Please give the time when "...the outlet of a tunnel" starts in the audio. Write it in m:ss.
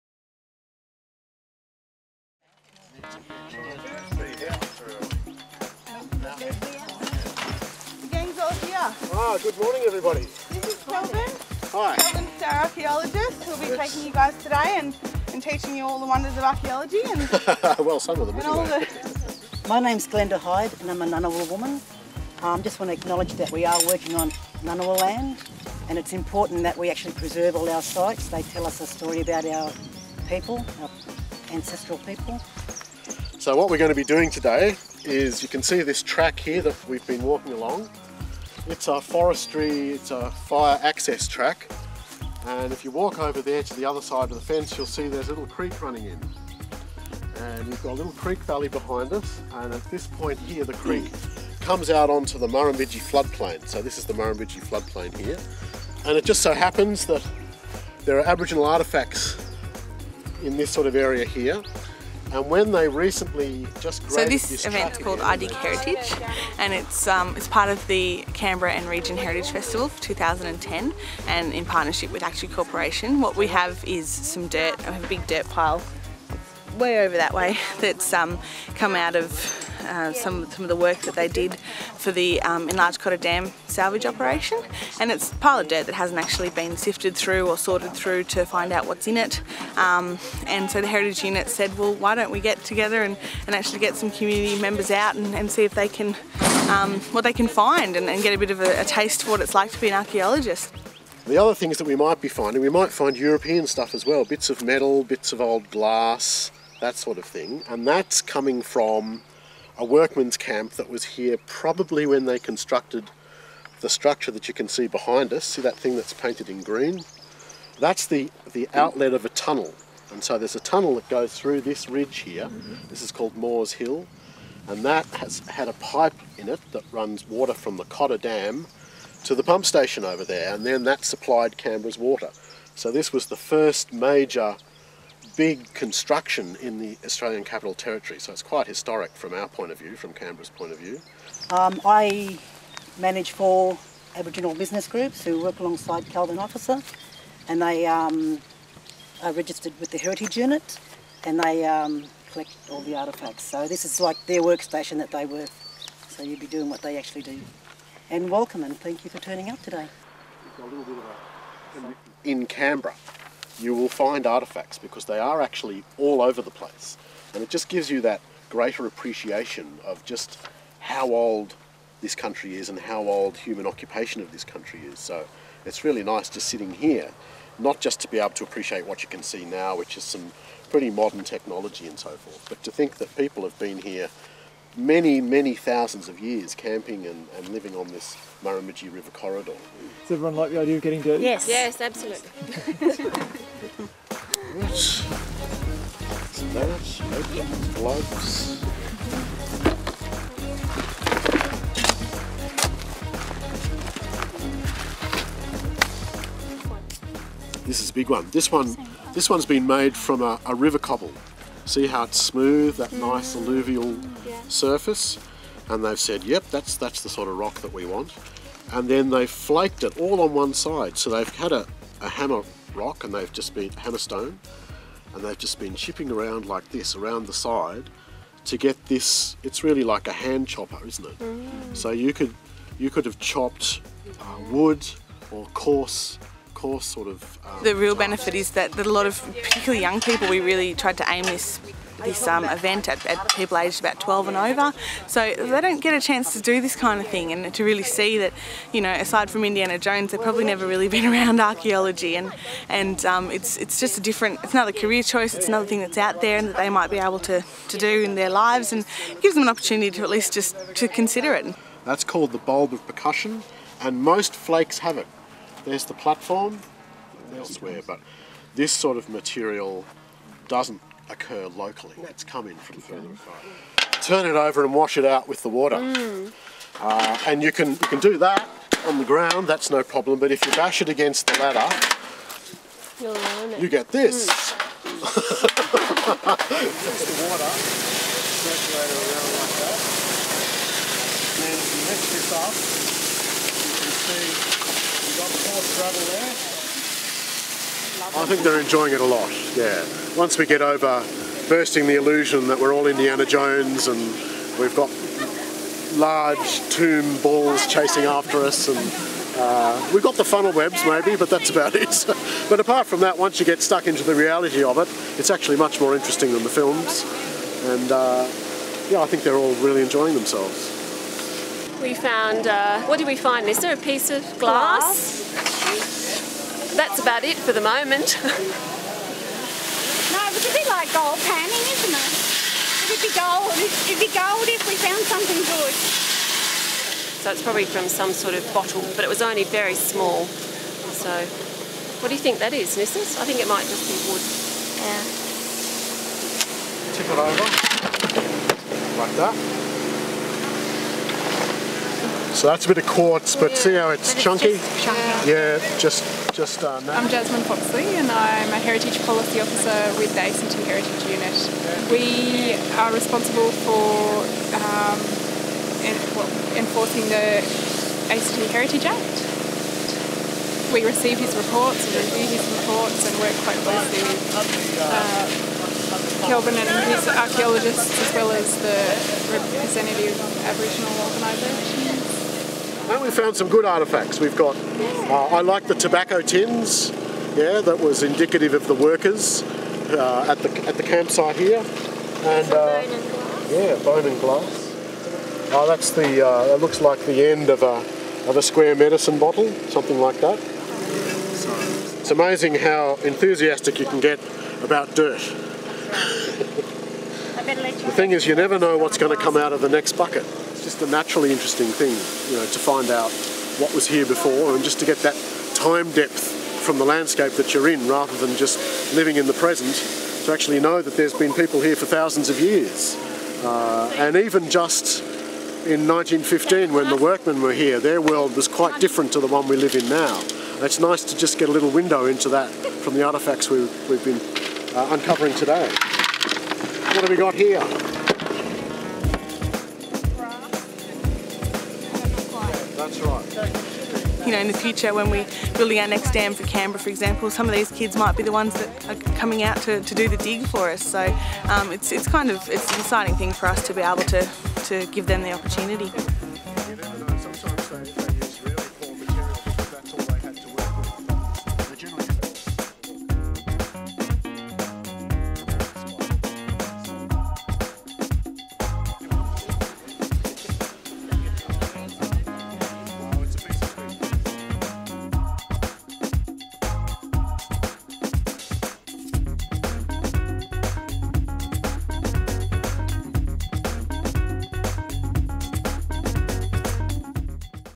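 1:58.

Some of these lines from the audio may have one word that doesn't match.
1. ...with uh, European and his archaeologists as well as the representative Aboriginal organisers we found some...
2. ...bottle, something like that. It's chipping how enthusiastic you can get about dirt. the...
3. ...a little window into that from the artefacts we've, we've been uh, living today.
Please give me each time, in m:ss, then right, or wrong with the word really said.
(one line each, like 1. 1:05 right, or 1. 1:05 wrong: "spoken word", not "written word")
1. 6:14 wrong: "Kelvin", not "European"
2. 6:39 wrong: "amazing", not "chipping"
3. 7:11 wrong: "uncovering", not "living".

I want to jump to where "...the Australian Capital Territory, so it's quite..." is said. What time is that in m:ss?
2:16.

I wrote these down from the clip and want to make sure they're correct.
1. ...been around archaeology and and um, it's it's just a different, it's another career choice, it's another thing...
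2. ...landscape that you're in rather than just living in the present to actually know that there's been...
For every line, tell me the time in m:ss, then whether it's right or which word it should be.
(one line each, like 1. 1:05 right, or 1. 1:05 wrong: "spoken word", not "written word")
1. 4:10 right
2. 6:56 right.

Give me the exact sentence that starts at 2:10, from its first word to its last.
And then that supplied Canberra's water.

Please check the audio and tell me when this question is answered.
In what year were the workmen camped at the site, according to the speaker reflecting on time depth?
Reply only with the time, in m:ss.
7:05.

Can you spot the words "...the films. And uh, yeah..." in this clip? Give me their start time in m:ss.
5:16.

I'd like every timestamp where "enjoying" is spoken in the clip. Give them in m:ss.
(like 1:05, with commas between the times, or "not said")
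4:58, 5:19.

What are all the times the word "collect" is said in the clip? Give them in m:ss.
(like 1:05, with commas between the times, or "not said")
2:32.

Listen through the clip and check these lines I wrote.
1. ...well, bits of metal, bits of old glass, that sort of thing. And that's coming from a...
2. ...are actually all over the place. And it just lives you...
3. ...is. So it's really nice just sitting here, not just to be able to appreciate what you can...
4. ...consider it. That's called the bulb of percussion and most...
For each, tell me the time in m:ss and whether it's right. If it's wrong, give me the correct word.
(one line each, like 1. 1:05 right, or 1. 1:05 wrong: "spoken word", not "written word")
1. 1:44 right
2. 2:45 wrong: "gives", not "lives"
3. 2:54 right
4. 4:20 right.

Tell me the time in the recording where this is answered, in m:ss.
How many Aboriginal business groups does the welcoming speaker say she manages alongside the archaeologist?
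2:23.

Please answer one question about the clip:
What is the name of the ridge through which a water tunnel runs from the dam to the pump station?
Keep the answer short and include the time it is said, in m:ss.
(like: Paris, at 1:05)
Moores Hill, at 2:03.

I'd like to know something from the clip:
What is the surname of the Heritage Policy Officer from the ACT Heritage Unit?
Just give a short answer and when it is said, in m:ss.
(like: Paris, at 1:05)
Foxley, at 5:57.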